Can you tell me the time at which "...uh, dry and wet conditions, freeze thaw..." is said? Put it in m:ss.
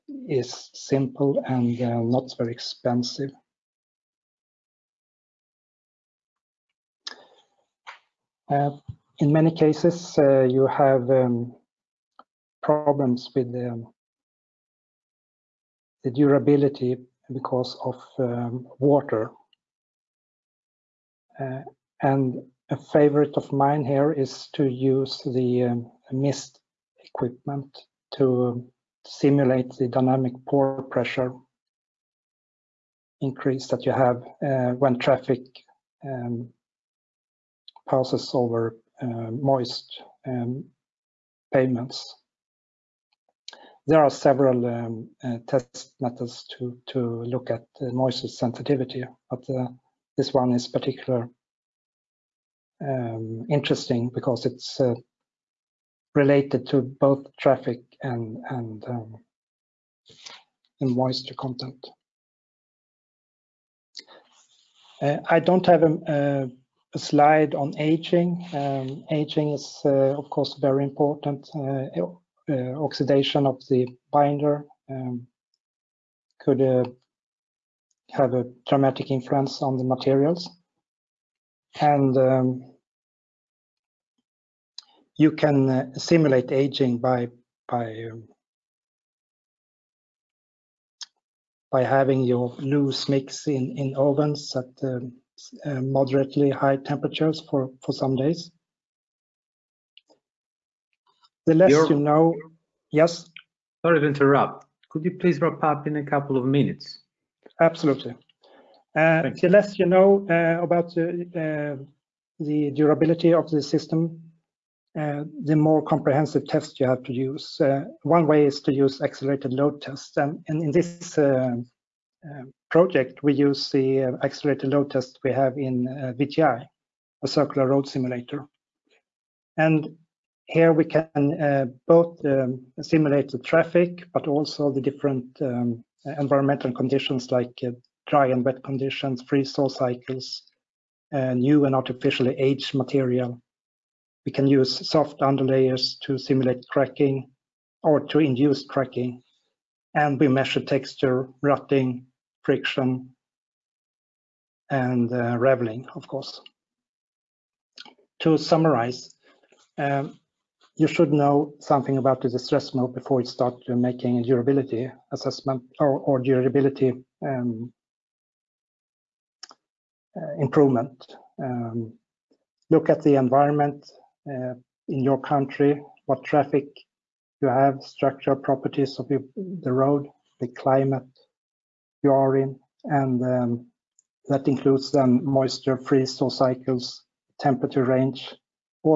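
2:17.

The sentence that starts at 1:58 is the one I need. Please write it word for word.
one way is to use accelerated load tests.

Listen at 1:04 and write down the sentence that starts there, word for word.
Uh, I don't have a, um, a a slide on aging.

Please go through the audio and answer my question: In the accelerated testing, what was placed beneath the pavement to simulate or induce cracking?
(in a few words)
Soft underlayers.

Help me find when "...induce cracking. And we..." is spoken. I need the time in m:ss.
2:28.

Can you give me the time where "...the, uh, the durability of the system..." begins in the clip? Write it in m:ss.
1:50.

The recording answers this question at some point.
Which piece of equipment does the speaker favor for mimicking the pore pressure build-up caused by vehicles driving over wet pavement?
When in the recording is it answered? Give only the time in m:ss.
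0:26.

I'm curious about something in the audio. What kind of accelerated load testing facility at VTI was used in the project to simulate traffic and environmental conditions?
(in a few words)
Circular road simulator.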